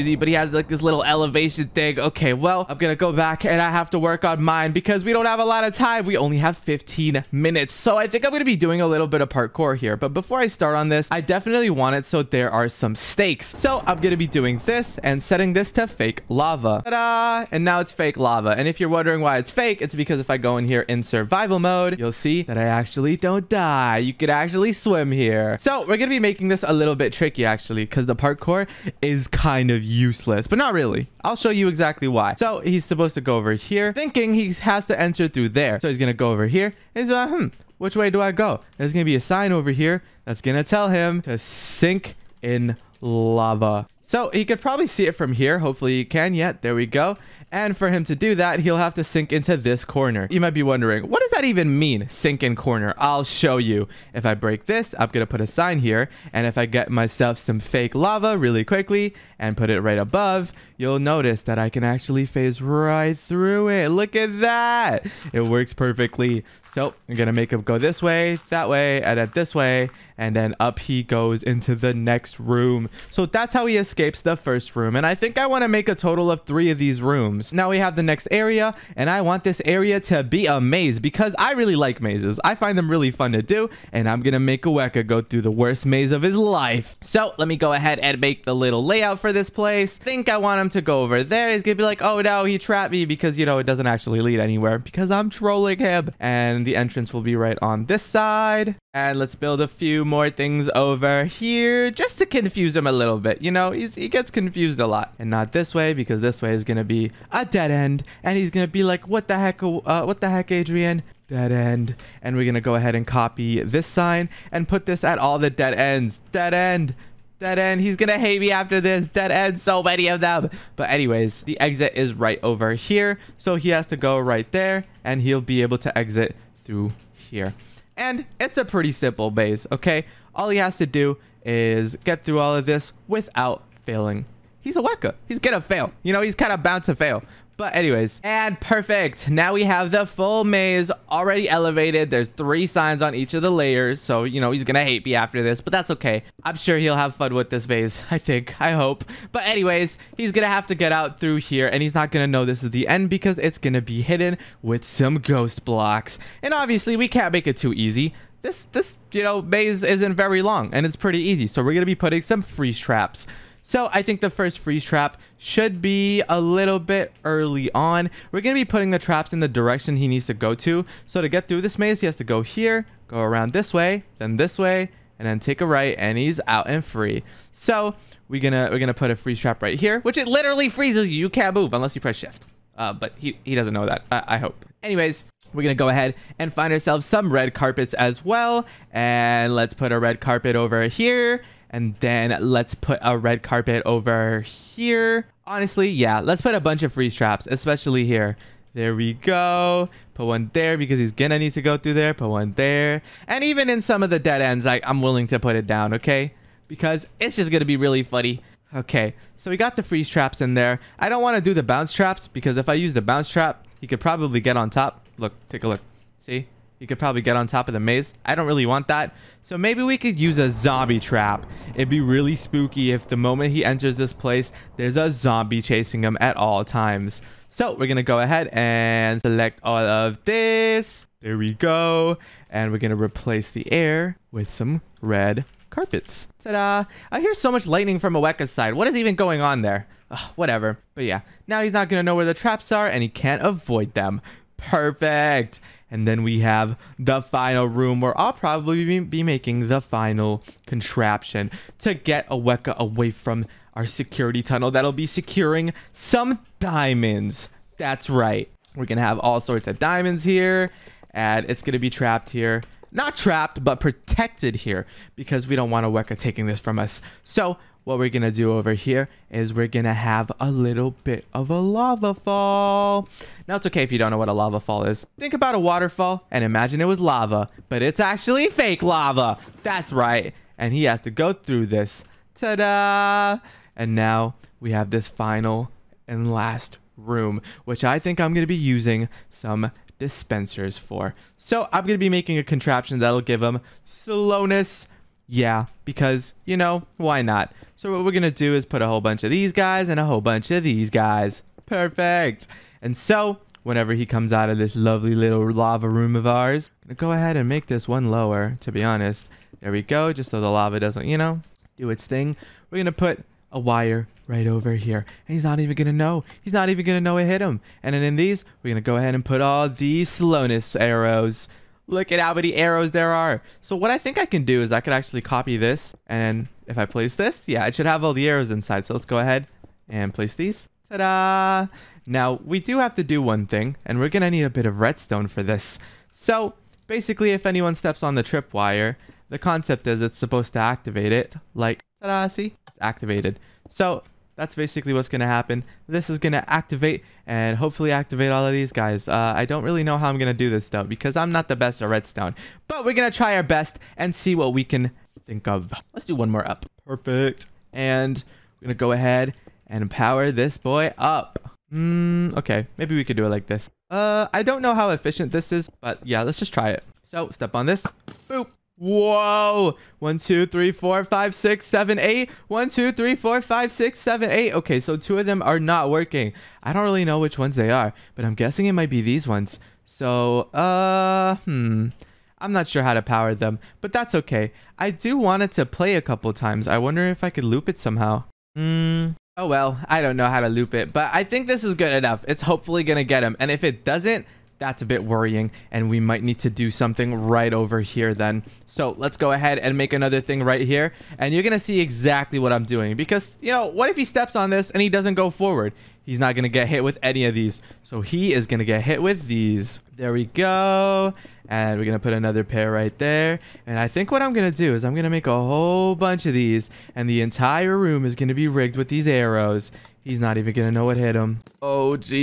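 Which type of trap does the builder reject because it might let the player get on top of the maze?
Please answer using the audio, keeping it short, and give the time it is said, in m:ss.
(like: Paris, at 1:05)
Bounce traps, at 3:31.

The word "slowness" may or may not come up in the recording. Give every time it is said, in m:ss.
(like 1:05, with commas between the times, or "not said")
4:53, 5:20.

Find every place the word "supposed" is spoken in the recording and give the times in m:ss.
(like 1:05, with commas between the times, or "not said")
0:32, 5:40.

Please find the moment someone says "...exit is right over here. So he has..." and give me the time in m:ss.
2:01.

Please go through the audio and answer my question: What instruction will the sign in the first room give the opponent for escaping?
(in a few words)
Sink in lava.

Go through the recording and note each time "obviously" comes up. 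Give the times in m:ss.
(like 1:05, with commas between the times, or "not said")
2:36.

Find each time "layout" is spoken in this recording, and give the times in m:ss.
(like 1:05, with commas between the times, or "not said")
1:28.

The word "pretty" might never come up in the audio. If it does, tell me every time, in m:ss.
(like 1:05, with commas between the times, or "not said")
2:08, 2:40.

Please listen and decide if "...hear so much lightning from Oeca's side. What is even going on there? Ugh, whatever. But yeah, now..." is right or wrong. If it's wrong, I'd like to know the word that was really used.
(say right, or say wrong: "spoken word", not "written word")
right.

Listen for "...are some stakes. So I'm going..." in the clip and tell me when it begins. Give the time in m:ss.
0:12.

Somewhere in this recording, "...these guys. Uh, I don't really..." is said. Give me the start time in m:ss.
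5:48.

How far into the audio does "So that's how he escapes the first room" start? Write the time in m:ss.
1:13.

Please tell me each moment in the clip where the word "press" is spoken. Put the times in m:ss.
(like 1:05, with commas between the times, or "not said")
3:02.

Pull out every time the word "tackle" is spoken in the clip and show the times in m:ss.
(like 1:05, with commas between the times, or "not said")
not said.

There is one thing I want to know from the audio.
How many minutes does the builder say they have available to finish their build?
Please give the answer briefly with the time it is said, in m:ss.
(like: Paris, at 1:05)
15, at 0:06.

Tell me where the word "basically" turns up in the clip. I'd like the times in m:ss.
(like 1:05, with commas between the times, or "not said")
5:36, 5:44.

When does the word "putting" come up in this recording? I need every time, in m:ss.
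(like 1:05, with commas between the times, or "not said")
2:41, 2:48.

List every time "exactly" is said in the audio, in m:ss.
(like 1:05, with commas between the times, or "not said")
0:31, 6:41.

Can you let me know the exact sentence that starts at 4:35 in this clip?
Think about a waterfall and imagine it was lava, but it's actually fake lava.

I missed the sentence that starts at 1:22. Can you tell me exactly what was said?
I find them really fun to do, and I'm going to make Oeca go through the worst maze of his life.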